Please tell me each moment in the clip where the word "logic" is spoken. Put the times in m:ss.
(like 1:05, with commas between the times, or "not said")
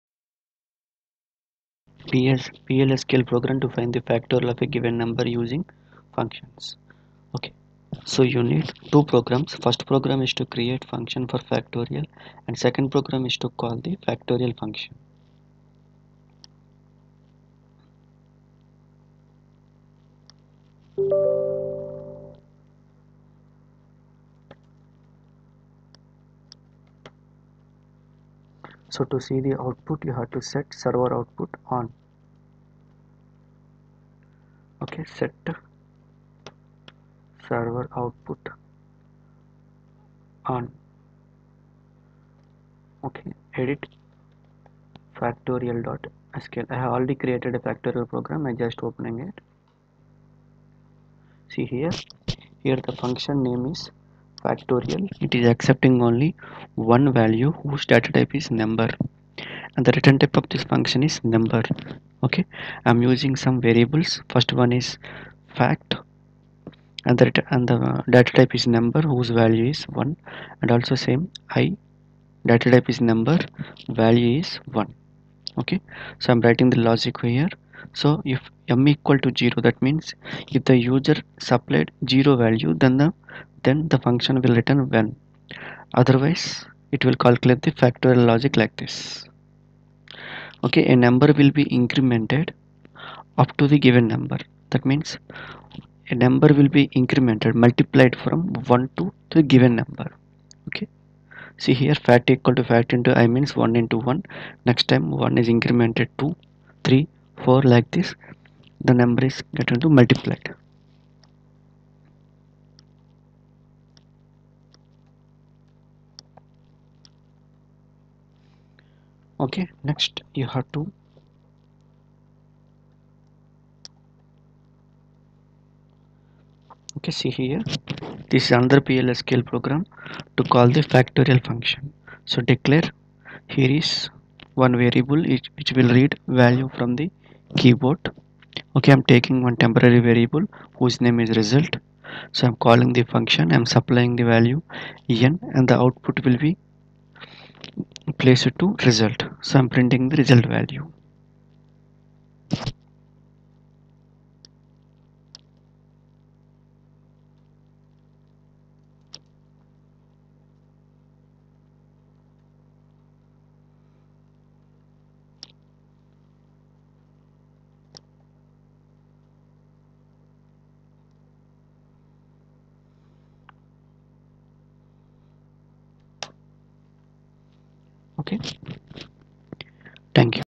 1:16, 1:28.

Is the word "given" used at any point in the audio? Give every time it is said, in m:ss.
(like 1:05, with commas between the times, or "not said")
0:04, 1:33, 1:39.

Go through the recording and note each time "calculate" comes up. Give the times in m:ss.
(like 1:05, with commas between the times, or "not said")
1:27.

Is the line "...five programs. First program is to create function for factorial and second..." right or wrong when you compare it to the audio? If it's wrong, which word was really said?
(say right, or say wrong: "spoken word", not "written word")
wrong: "two", not "five".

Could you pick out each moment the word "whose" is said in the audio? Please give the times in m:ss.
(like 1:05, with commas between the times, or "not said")
0:57, 1:09, 2:20.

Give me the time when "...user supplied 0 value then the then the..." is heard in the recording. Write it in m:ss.
1:20.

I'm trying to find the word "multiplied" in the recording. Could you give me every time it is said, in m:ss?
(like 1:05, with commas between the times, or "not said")
1:37, 1:50.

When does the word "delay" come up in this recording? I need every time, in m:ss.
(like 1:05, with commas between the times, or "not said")
not said.